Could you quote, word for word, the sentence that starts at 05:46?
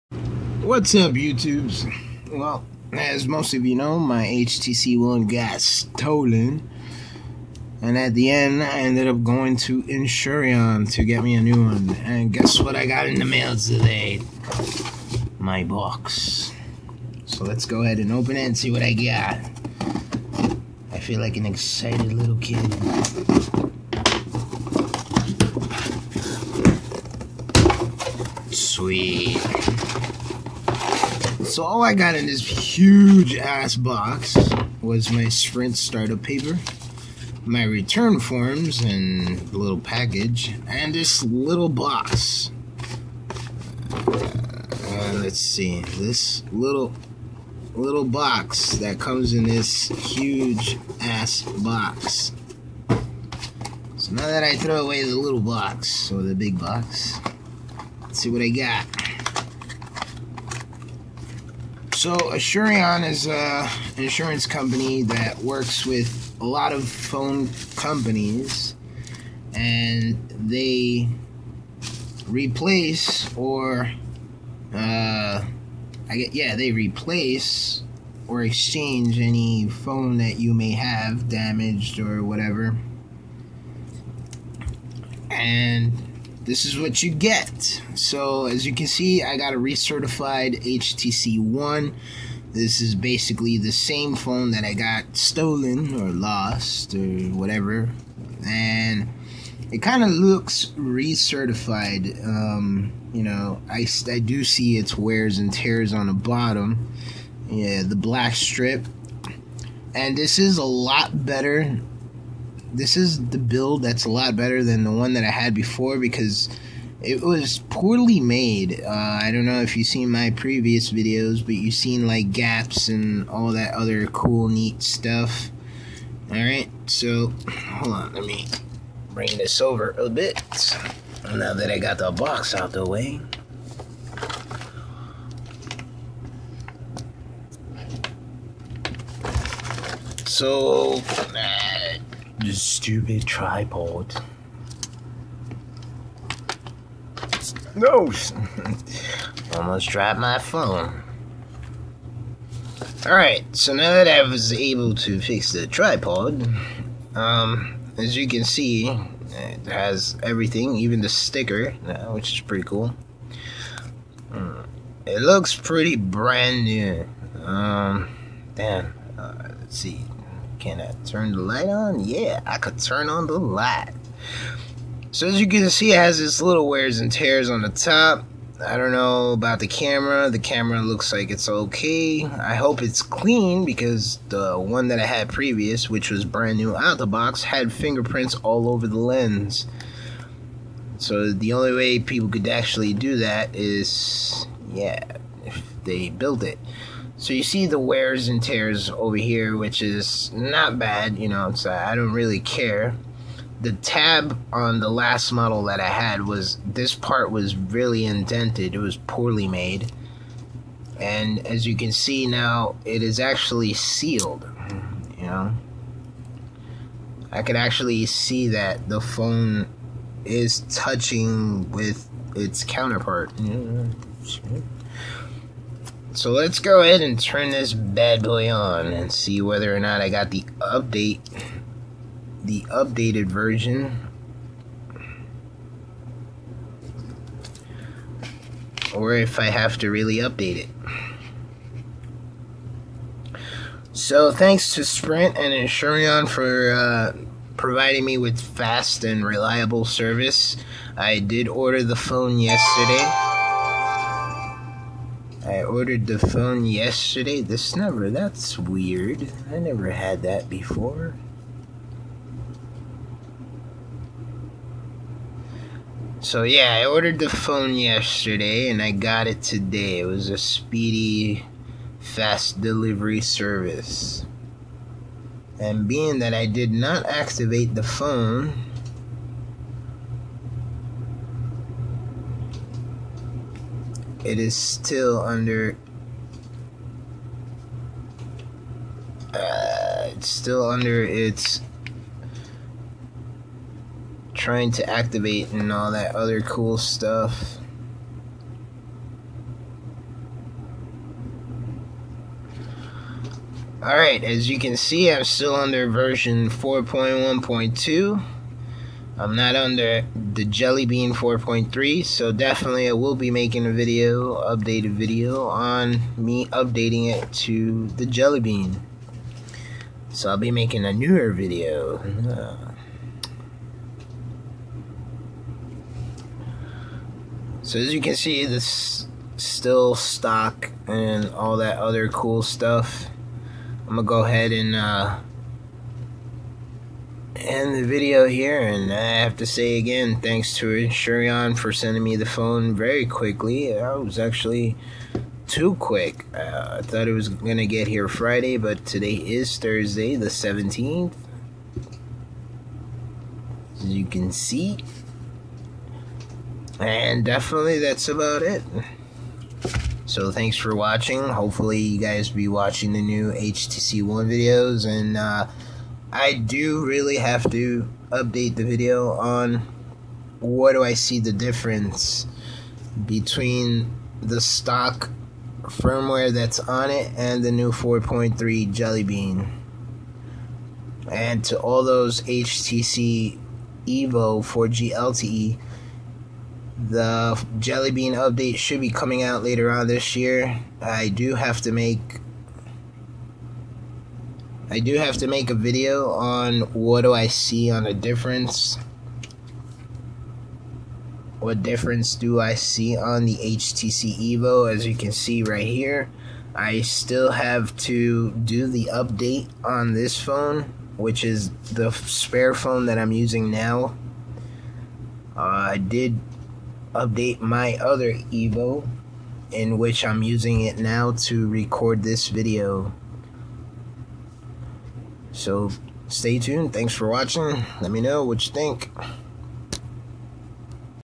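Uh, I thought it was going to get here Friday, but today is Thursday, the 17th.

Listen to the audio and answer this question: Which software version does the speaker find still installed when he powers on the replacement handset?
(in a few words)
4.1.2.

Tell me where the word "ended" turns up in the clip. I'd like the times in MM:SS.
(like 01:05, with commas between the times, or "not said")
00:08.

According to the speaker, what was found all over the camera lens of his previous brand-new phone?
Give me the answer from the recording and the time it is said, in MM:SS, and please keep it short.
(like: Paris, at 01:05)
fingerprints, at 03:07.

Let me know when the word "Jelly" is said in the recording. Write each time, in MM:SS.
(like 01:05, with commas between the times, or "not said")
05:10, 05:18, 06:18, 06:27.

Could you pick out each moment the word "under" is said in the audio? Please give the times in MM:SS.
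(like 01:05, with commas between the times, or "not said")
04:45, 04:50, 05:05, 05:09.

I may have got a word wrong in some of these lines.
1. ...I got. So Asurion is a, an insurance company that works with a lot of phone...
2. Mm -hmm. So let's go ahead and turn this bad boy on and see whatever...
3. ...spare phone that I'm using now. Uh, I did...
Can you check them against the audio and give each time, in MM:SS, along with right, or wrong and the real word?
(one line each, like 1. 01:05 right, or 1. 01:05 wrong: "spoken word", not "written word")
1. 00:58 right
2. 03:43 wrong: "whether", not "whatever"
3. 06:51 right.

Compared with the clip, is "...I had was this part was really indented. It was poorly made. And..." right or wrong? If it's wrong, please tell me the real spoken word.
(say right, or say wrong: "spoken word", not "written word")
right.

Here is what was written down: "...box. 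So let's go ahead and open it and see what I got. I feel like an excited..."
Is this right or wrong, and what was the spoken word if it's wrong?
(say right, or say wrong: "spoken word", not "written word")
right.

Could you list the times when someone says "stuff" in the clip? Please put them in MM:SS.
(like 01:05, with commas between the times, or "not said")
02:04, 04:56, 05:32.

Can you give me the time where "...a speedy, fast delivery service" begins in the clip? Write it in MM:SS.
04:30.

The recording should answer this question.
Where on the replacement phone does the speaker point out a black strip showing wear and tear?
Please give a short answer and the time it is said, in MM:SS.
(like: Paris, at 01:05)
the bottom, at 01:46.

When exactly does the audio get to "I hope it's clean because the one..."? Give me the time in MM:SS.
03:02.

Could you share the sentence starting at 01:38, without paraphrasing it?
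And it kind of looks recertified.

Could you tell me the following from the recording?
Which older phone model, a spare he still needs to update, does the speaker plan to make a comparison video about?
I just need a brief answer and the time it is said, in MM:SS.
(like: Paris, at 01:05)
HTC Evo 4G LTE, at 06:22.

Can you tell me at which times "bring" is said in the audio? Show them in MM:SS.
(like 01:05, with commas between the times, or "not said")
02:09.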